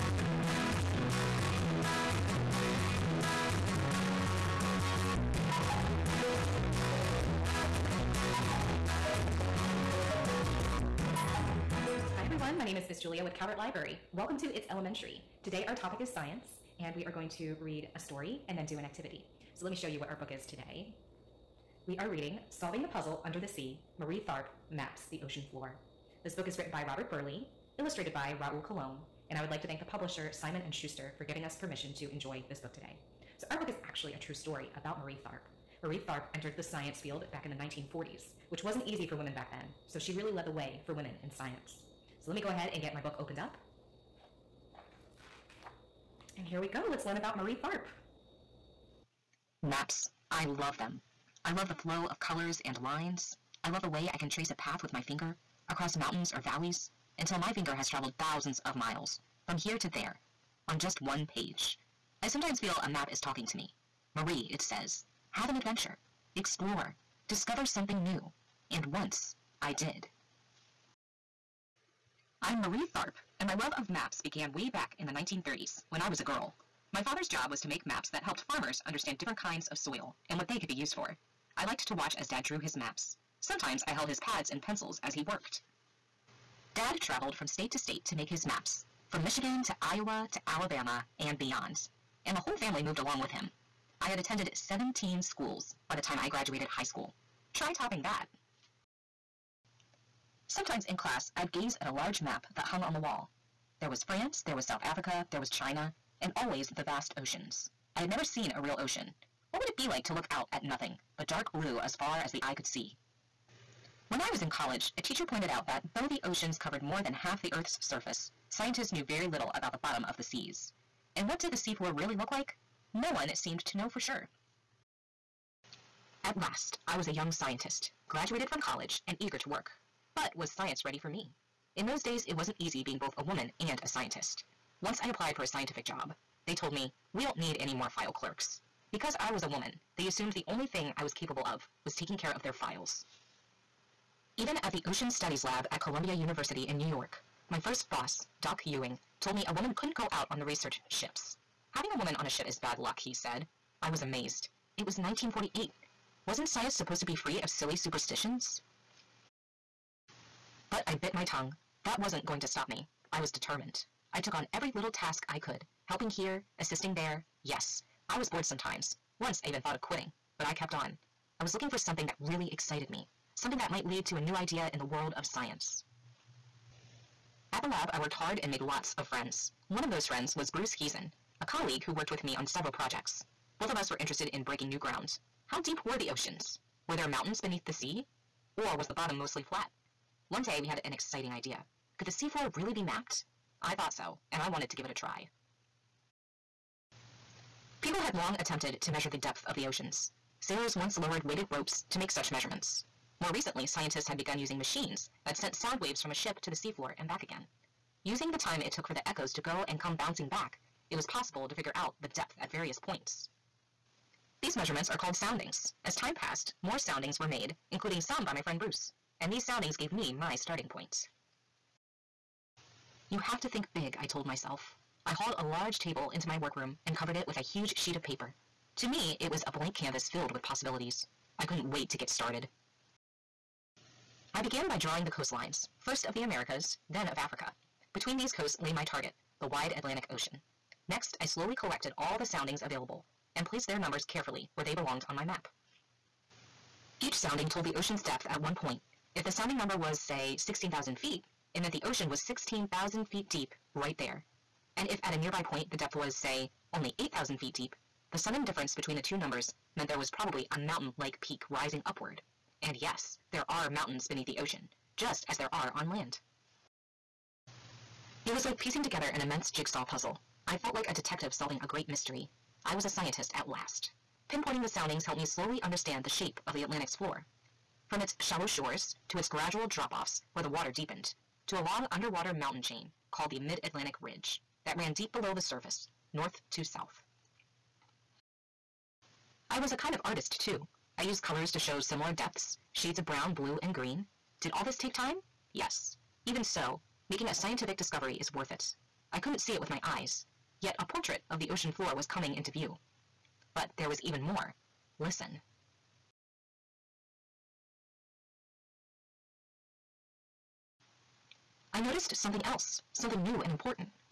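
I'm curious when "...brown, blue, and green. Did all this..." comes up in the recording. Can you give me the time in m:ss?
4:53.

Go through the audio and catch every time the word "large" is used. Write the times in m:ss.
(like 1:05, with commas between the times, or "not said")
1:41, 3:45.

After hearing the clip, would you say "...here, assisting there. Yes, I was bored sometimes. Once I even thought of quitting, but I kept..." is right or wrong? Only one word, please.
right.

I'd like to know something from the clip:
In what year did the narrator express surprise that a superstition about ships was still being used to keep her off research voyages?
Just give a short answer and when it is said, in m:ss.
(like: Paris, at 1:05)
1948, at 2:34.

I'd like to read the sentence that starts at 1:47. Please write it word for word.
I had never seen a real ocean.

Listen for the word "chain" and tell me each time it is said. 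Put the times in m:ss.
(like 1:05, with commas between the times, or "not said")
4:42.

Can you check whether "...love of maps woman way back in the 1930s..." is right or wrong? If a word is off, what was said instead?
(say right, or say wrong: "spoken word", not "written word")
wrong: "began", not "woman".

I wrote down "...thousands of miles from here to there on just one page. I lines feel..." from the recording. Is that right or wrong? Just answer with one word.
wrong.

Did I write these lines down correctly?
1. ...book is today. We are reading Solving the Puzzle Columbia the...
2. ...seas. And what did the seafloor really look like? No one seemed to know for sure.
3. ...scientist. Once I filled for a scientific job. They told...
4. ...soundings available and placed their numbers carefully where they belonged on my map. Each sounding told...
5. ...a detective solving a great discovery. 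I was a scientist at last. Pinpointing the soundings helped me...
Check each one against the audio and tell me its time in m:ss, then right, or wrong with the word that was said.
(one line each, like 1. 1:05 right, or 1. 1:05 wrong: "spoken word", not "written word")
1. 0:20 wrong: "Under", not "Columbia"
2. 2:00 right
3. 2:13 wrong: "applied", not "filled"
4. 4:02 right
5. 4:30 wrong: "mystery", not "discovery".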